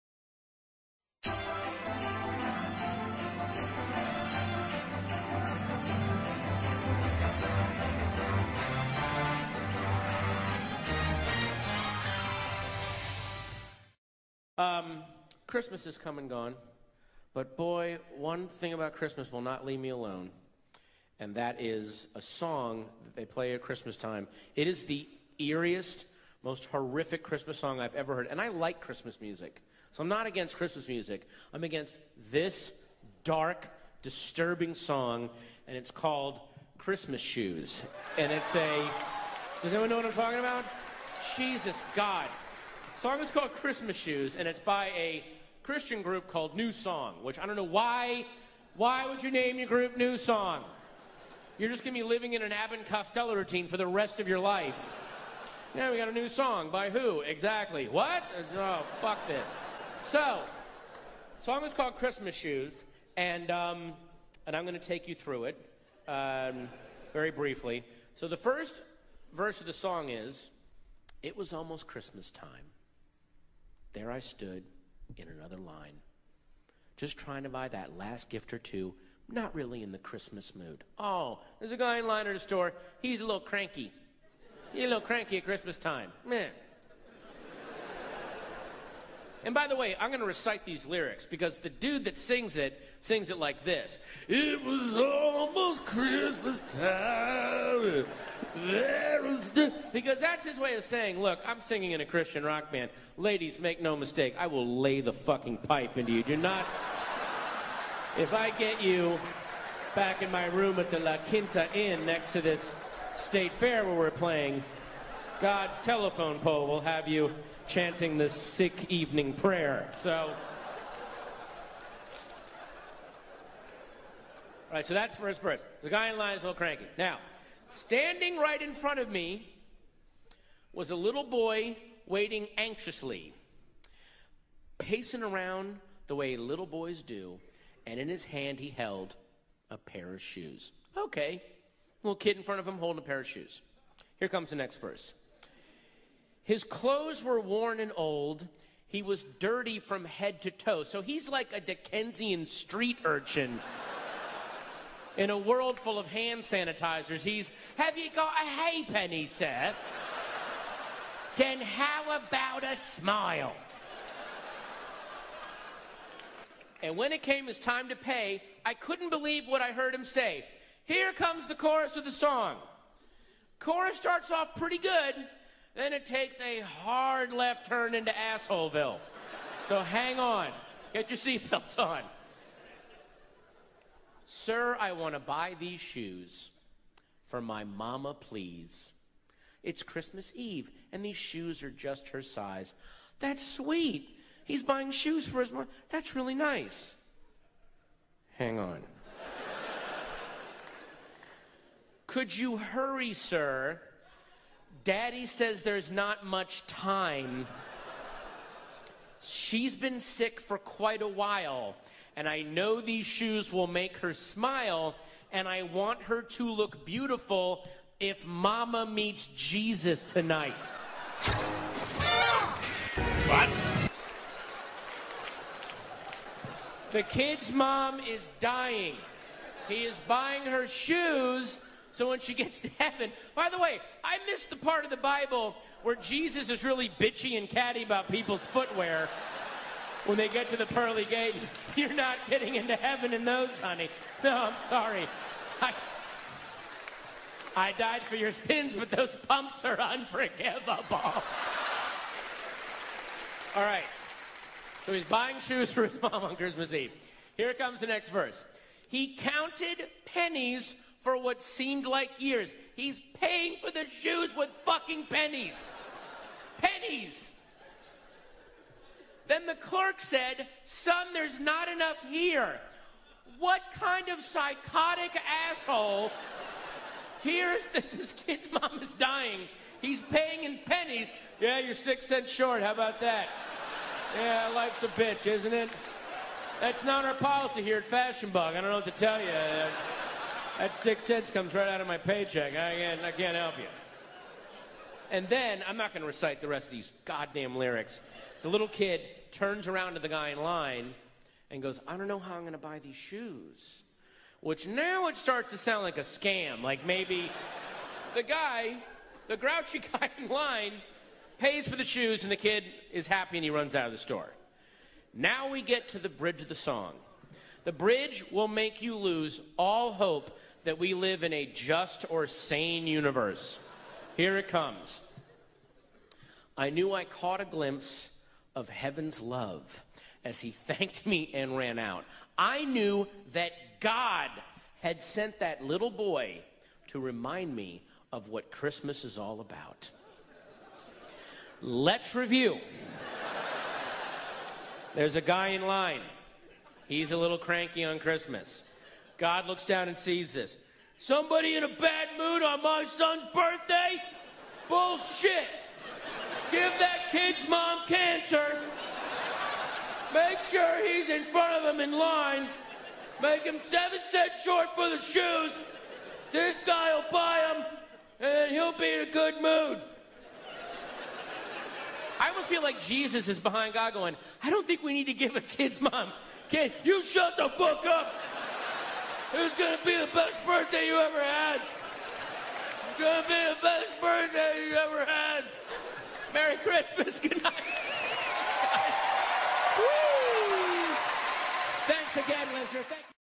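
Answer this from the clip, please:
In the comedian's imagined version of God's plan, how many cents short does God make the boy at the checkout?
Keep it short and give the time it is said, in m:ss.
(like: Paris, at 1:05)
7, at 6:03.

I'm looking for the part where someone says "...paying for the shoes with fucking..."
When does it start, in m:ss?
4:23.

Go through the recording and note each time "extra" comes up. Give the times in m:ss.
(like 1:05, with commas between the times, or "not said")
not said.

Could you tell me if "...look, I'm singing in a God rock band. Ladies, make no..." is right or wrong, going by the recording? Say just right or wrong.
wrong.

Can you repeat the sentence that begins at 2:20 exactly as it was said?
Okay, little kid in front of him holding a pair of shoes.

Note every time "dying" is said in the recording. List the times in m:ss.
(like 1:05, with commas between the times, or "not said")
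3:48, 4:38.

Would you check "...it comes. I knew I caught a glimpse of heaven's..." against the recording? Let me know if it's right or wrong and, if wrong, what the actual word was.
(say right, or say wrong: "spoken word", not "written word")
right.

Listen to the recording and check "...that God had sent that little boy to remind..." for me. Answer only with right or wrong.
right.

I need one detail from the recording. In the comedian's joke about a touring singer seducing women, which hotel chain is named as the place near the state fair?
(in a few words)
La Quinta Inn.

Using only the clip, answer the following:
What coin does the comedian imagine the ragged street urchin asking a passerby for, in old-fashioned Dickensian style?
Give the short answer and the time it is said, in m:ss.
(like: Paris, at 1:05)
halfpenny, at 2:38.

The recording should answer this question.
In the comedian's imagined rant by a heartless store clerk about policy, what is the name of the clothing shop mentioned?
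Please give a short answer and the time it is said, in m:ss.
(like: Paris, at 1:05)
Fashion Bug, at 4:47.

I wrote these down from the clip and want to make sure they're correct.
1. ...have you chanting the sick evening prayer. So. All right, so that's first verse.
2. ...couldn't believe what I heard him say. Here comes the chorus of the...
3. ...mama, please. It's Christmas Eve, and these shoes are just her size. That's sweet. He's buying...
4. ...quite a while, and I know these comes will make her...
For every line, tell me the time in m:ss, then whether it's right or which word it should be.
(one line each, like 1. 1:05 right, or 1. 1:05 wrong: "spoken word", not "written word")
1. 1:56 right
2. 2:48 right
3. 3:07 right
4. 3:30 wrong: "shoes", not "comes".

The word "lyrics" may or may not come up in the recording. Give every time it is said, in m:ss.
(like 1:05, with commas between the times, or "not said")
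1:30, 4:57.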